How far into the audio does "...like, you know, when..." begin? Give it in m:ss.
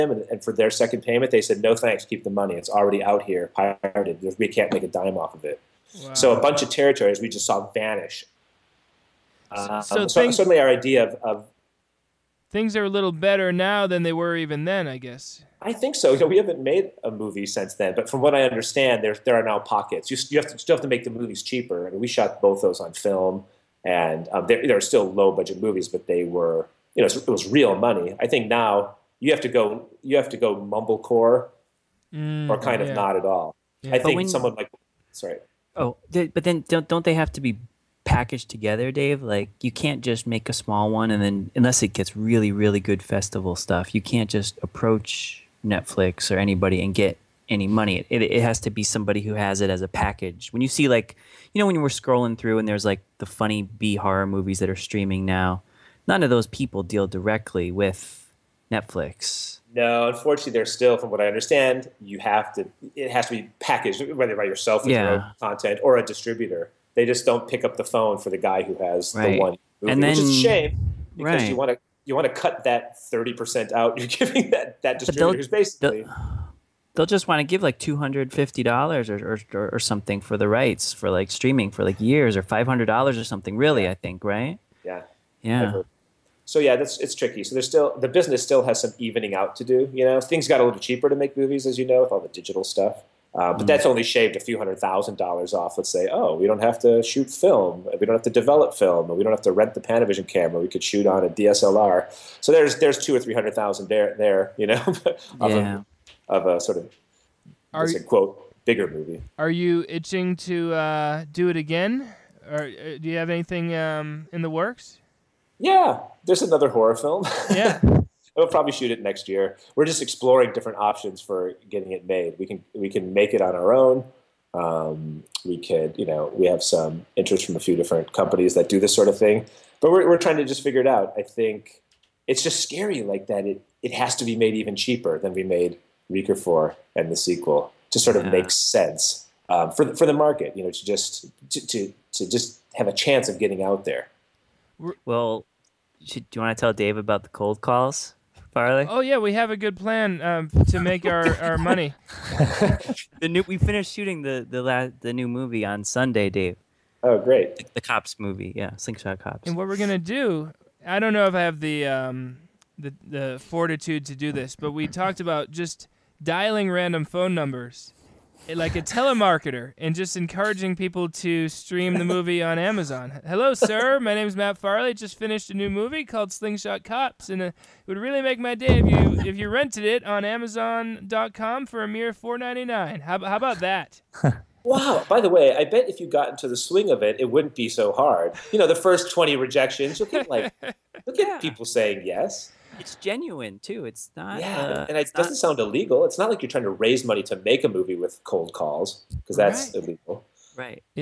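0:50.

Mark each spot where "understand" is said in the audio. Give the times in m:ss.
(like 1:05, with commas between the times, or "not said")
0:18, 1:01.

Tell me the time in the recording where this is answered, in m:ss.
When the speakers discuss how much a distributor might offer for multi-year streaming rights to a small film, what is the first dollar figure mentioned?
1:17.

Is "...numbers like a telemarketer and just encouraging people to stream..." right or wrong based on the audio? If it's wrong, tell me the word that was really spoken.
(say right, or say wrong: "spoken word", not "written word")
right.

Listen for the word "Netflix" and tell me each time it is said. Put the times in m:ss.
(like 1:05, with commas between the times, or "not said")
0:45, 0:58.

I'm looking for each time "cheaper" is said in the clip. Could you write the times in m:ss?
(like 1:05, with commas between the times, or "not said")
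0:21, 1:30, 2:14.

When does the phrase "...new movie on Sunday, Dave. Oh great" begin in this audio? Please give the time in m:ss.
2:35.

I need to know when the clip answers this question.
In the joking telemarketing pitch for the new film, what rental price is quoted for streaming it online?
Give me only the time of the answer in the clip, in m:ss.
3:02.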